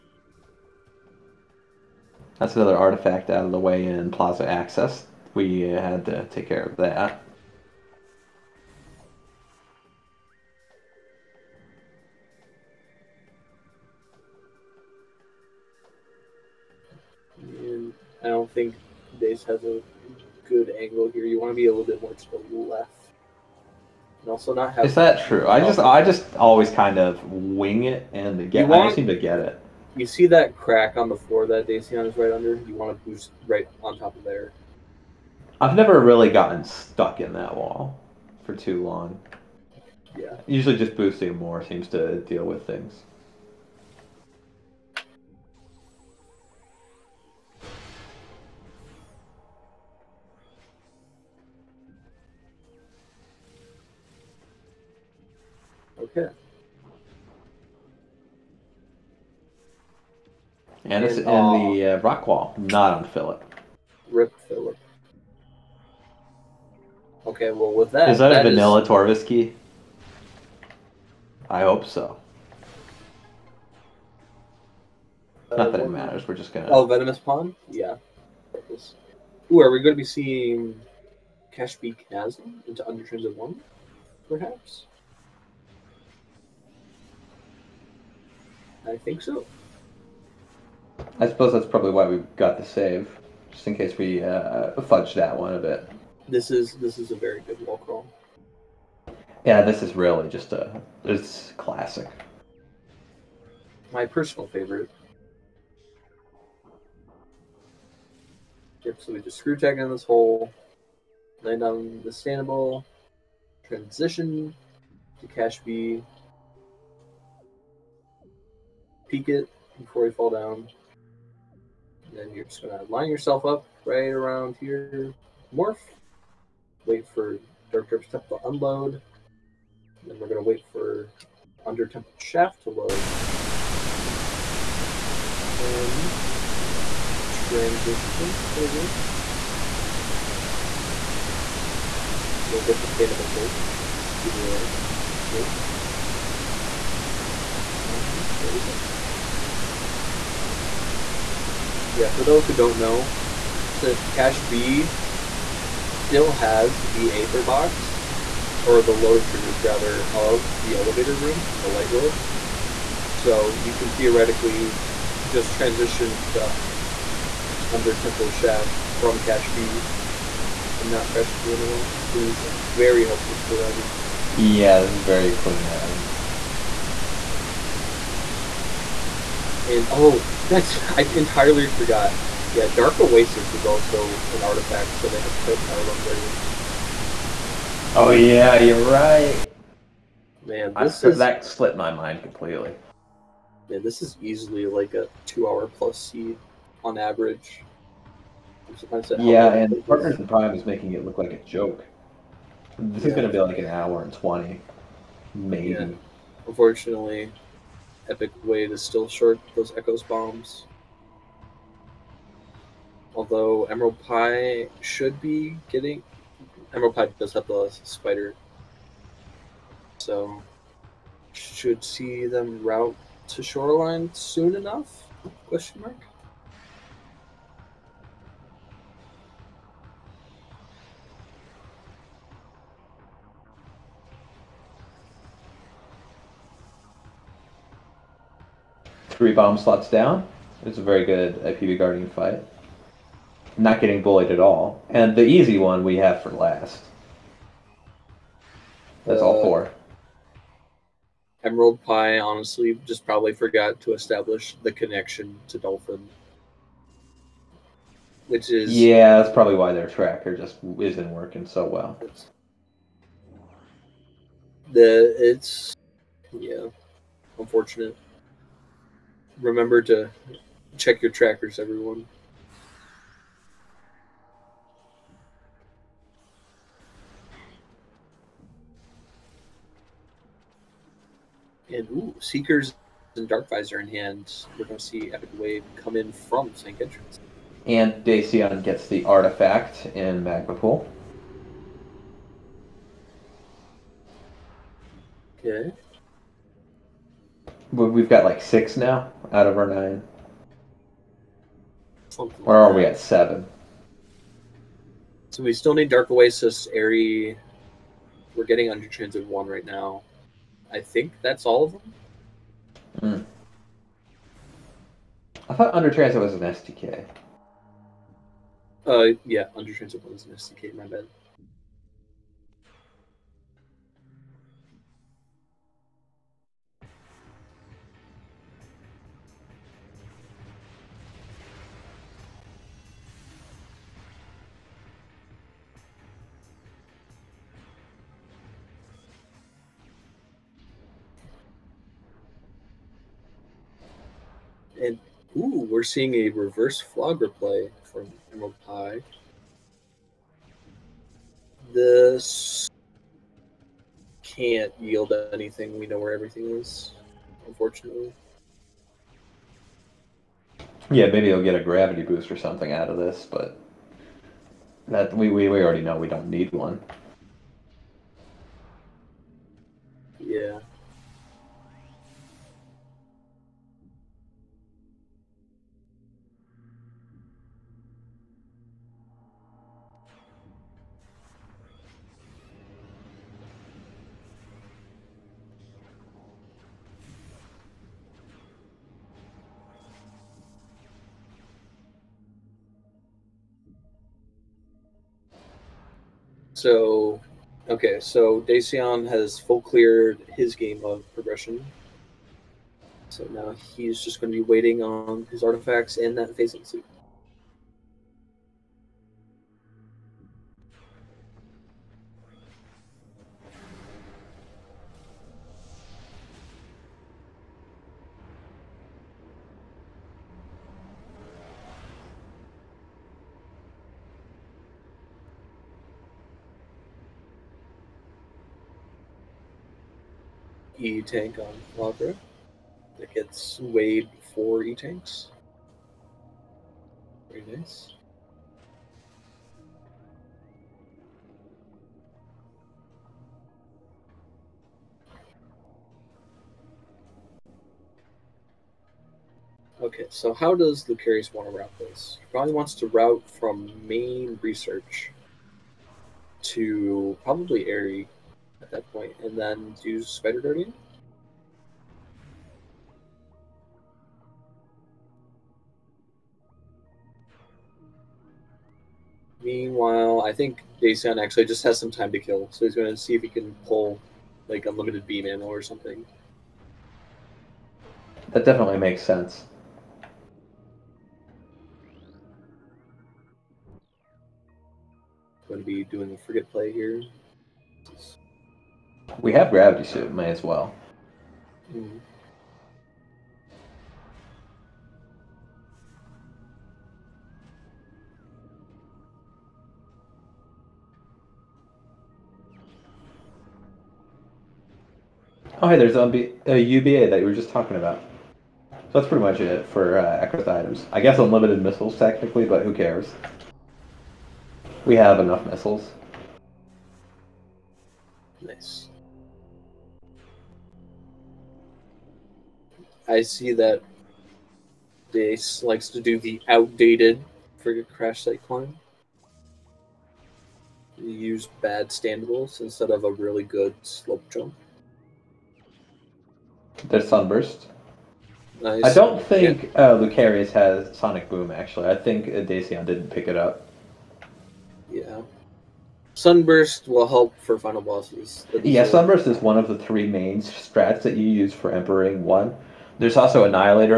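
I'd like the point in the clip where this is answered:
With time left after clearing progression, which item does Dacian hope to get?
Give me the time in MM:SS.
07:54.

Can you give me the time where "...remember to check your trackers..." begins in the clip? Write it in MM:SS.
04:29.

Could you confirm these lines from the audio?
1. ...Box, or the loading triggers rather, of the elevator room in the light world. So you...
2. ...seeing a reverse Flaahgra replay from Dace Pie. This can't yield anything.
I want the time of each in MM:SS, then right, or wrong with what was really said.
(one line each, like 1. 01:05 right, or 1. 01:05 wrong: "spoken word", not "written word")
1. 02:37 right
2. 05:45 wrong: "Emerald", not "Dace".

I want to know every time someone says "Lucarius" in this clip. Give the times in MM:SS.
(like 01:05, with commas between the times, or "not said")
07:30, 08:59.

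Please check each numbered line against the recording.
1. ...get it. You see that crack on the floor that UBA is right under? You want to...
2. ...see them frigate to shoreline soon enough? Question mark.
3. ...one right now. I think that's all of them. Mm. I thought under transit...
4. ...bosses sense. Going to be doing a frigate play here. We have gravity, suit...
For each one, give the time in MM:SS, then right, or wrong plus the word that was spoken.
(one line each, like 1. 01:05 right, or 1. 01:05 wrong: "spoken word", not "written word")
1. 00:29 wrong: "Dacian", not "UBA"
2. 03:41 wrong: "route", not "frigate"
3. 05:09 right
4. 07:58 wrong: "makes", not "bosses".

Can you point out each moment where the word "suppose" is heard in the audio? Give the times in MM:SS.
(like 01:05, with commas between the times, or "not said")
01:31.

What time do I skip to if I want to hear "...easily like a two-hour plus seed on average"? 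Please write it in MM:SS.
03:14.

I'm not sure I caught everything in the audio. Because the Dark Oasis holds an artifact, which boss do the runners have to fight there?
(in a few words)
Bomb Guardian.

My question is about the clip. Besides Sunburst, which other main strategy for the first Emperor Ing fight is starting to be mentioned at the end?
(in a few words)
Annihilator.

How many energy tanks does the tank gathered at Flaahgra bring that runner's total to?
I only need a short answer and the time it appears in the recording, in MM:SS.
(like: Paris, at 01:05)
4, at 07:14.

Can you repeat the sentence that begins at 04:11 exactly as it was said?
Emerald Pie, honestly, just probably forgot to establish the connection to Dolphin.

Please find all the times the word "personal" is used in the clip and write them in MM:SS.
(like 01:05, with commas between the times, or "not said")
01:44.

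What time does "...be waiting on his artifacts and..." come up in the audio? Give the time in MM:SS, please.
06:44.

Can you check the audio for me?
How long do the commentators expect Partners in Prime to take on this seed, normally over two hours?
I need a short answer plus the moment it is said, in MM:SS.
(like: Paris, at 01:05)
an hour and twenty, at 03:23.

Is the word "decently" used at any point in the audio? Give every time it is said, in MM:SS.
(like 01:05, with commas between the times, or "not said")
not said.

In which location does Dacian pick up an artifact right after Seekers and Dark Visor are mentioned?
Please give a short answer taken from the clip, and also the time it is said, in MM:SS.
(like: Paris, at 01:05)
Magma Pool, at 04:50.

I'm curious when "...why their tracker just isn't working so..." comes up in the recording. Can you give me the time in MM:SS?
04:19.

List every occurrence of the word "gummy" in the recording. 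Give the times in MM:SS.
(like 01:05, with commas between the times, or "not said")
not said.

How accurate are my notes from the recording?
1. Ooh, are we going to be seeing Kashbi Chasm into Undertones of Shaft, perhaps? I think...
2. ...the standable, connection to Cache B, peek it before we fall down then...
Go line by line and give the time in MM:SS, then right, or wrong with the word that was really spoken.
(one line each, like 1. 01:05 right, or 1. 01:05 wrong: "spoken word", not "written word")
1. 01:19 wrong: "One", not "Shaft"
2. 01:52 wrong: "transition", not "connection".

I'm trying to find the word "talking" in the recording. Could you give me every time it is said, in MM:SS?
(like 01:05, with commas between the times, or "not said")
08:27.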